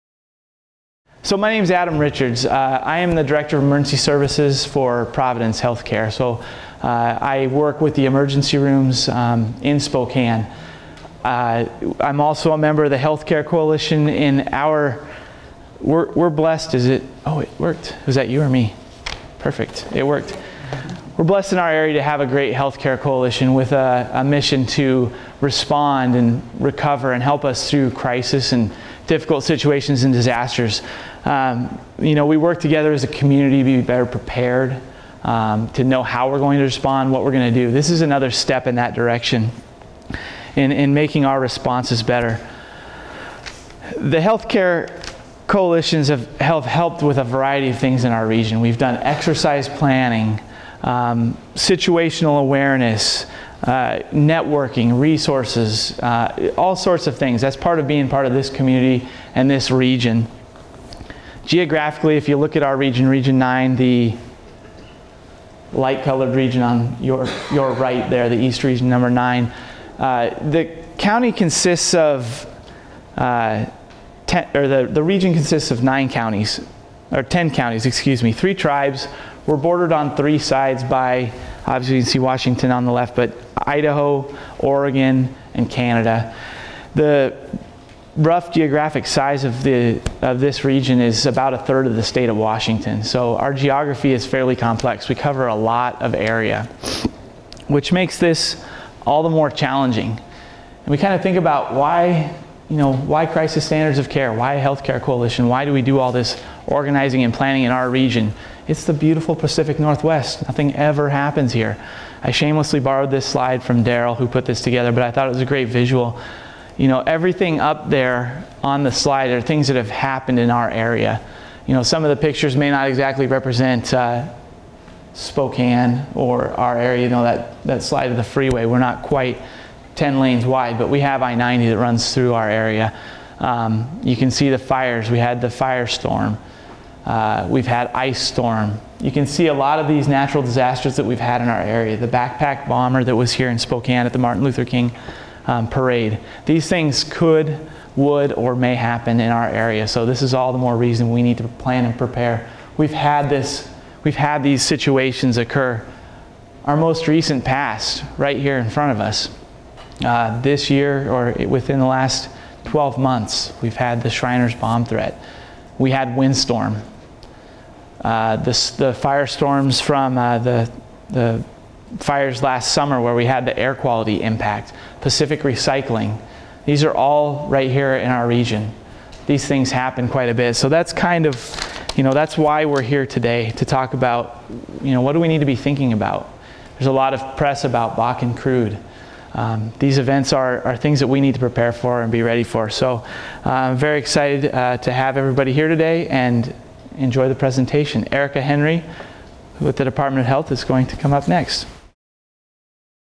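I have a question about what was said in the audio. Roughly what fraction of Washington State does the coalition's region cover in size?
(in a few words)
a third.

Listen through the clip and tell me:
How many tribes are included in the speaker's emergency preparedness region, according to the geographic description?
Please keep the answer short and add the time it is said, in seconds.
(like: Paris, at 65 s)
3, at 78 s.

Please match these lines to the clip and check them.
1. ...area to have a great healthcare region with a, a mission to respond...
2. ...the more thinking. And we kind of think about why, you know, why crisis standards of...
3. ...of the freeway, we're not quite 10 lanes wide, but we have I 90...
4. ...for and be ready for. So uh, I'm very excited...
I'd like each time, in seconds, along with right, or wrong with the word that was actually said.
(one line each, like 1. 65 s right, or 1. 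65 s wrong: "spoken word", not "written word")
1. 21 s wrong: "coalition", not "region"
2. 99 s wrong: "challenging", not "thinking"
3. 128 s right
4. 191 s right.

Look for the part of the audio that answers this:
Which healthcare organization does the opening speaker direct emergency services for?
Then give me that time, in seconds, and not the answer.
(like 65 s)
5 s.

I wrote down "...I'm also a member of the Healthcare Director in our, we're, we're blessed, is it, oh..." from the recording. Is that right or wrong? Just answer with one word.
wrong.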